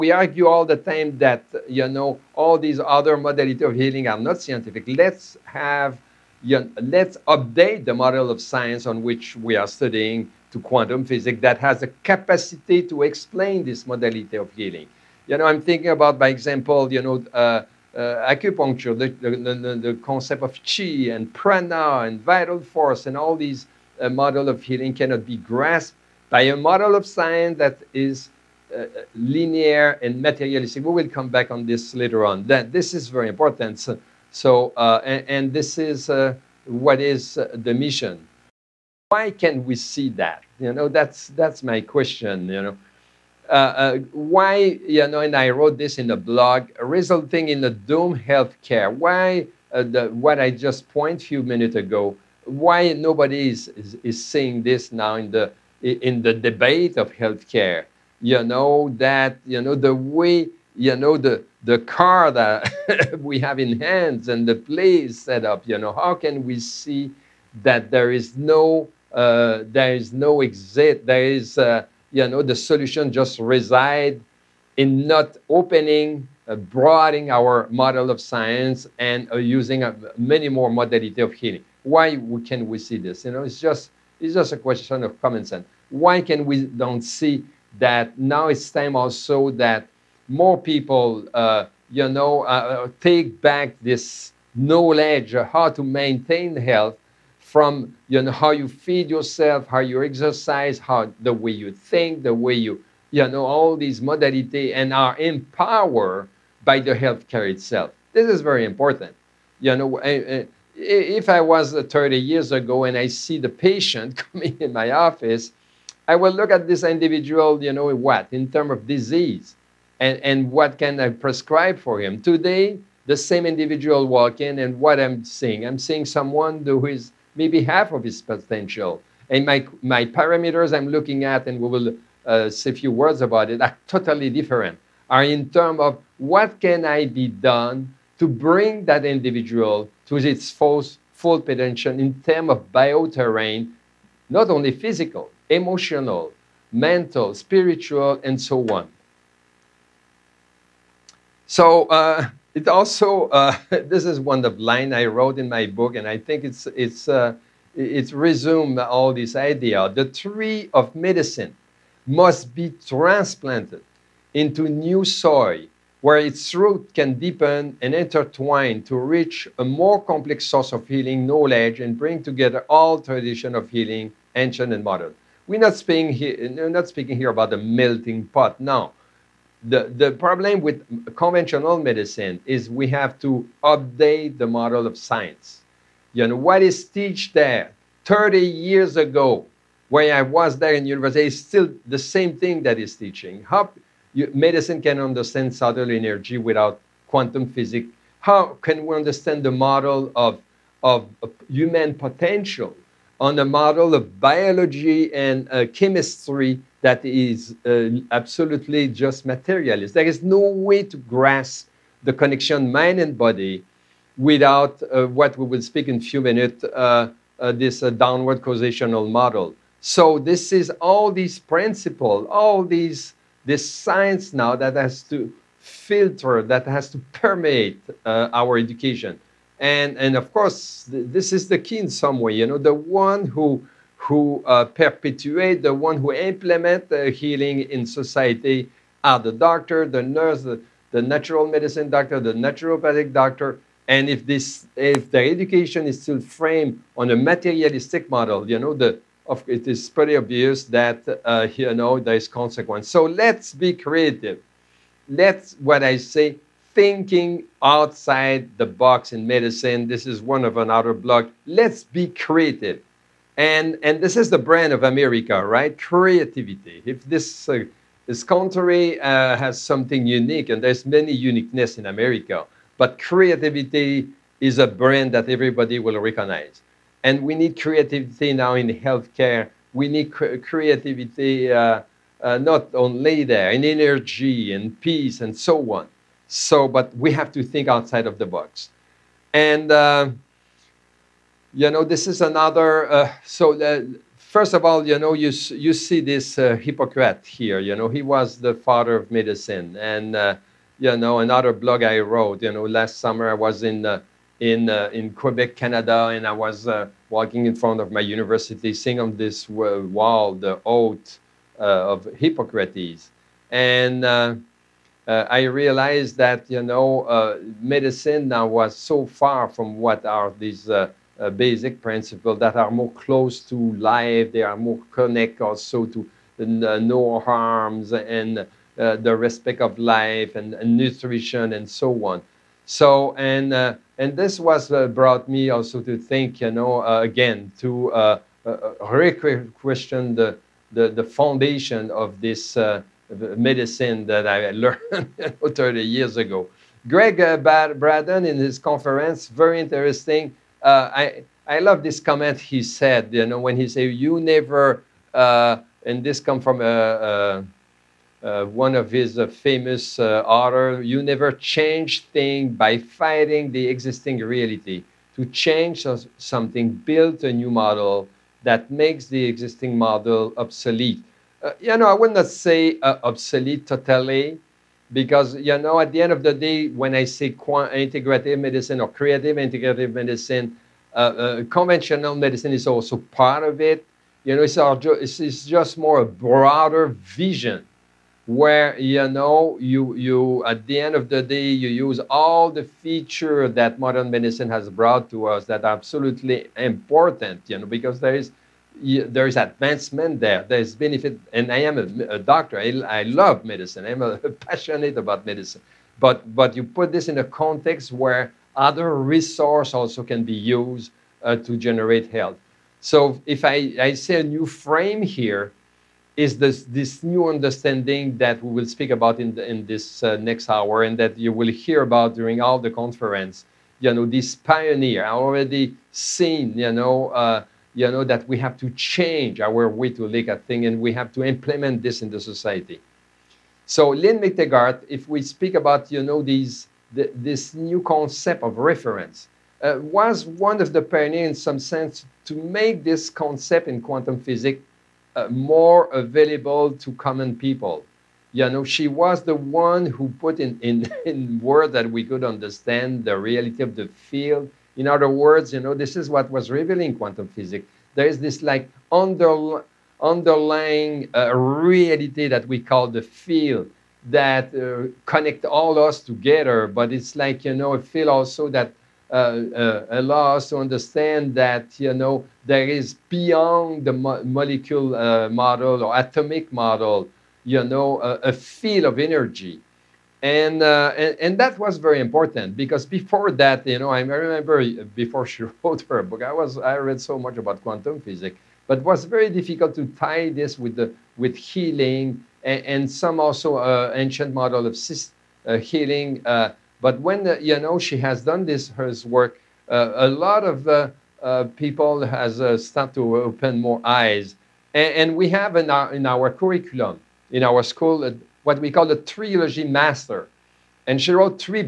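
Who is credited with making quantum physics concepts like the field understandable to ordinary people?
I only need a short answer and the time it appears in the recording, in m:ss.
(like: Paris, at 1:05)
Lynn McTaggart, at 7:13.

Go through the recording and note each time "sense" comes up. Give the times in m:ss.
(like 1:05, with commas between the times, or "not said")
1:25, 7:21.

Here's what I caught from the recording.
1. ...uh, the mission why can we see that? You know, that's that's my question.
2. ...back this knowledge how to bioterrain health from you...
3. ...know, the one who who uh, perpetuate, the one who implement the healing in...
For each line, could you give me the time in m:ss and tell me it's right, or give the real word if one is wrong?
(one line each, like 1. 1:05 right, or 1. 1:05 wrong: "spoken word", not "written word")
1. 0:37 right
2. 1:33 wrong: "maintain", not "bioterrain"
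3. 3:52 right.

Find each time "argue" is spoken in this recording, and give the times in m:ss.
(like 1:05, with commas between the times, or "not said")
0:00.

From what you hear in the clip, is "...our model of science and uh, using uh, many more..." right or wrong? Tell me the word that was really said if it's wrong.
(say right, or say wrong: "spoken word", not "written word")
right.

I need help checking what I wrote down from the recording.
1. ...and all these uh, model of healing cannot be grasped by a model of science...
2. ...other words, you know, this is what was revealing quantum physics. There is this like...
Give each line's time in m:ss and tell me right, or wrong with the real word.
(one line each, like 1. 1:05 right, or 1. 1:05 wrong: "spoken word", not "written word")
1. 0:23 right
2. 7:34 right.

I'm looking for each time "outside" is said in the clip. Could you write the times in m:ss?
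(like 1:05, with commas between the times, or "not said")
4:17, 4:47.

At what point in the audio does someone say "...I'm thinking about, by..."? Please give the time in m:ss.
0:15.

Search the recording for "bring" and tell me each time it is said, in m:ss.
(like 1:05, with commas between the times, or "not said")
2:18, 2:51.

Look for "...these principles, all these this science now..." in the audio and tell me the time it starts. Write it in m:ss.
3:41.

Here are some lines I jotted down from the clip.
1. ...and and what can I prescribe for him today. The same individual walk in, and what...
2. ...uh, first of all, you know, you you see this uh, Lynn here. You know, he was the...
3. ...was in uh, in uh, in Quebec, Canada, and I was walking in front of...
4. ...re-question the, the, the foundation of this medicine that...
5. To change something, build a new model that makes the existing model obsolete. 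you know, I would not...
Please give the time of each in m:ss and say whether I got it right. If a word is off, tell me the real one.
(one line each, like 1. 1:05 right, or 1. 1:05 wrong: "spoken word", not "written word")
1. 1:59 right
2. 4:53 wrong: "Hippocrates", not "Lynn"
3. 5:03 right
4. 5:38 right
5. 6:05 right.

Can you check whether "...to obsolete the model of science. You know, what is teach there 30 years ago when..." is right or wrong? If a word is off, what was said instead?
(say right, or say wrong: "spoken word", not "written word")
wrong: "update", not "obsolete".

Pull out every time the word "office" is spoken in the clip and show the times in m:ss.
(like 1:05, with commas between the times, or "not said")
1:54.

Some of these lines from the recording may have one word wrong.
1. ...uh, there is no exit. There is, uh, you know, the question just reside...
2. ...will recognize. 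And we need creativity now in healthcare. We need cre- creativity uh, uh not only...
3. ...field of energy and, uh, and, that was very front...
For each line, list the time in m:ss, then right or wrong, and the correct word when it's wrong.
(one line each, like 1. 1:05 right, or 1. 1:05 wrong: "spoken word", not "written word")
1. 1:09 wrong: "solution", not "question"
2. 4:35 right
3. 7:58 wrong: "important", not "front".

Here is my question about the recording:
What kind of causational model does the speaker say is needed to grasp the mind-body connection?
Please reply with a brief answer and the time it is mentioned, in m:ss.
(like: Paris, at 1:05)
downward causational model, at 3:37.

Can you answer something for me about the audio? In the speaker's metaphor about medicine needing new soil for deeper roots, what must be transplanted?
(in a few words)
The tree of medicine.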